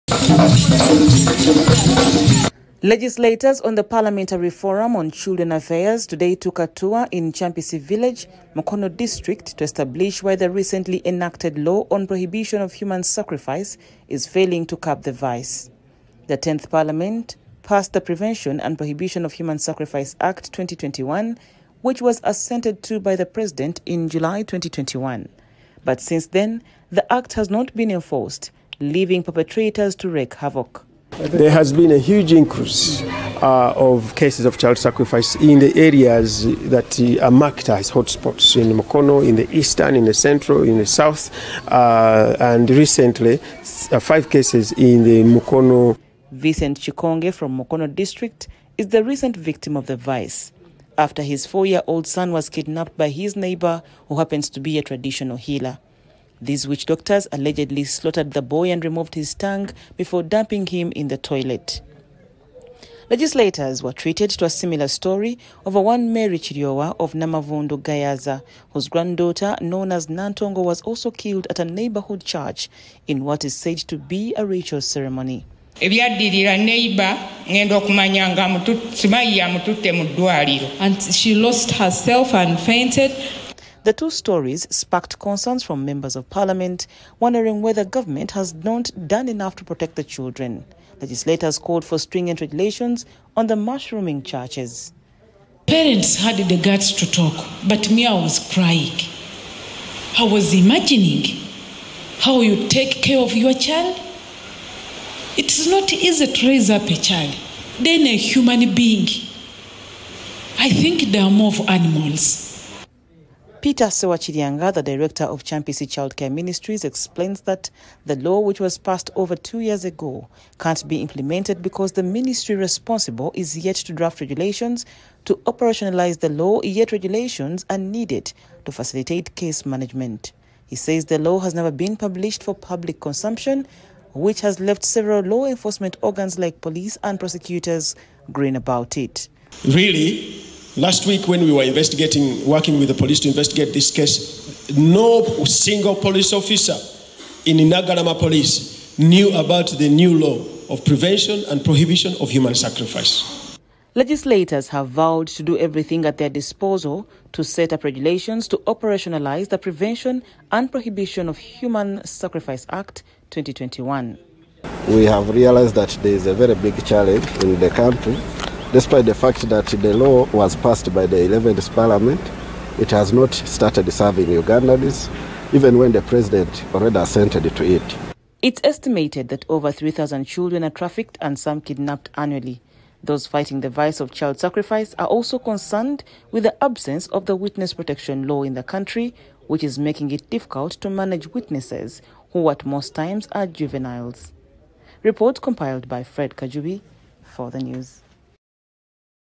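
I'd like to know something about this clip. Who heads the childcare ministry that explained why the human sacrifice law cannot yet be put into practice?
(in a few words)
Peter Sewakiryanga.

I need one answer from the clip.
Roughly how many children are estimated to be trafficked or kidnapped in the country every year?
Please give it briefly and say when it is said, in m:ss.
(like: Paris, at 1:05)
over 3,000, at 2:59.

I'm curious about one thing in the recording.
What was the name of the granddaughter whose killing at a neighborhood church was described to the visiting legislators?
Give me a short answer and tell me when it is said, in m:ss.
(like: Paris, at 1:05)
Nantongo, at 1:10.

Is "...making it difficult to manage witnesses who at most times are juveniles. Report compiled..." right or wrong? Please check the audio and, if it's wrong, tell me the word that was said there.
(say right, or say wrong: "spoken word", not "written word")
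right.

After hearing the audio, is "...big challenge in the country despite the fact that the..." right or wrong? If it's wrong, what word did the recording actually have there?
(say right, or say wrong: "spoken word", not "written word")
right.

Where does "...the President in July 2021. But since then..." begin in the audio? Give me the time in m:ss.
0:23.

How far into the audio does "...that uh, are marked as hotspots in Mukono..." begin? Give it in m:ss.
0:36.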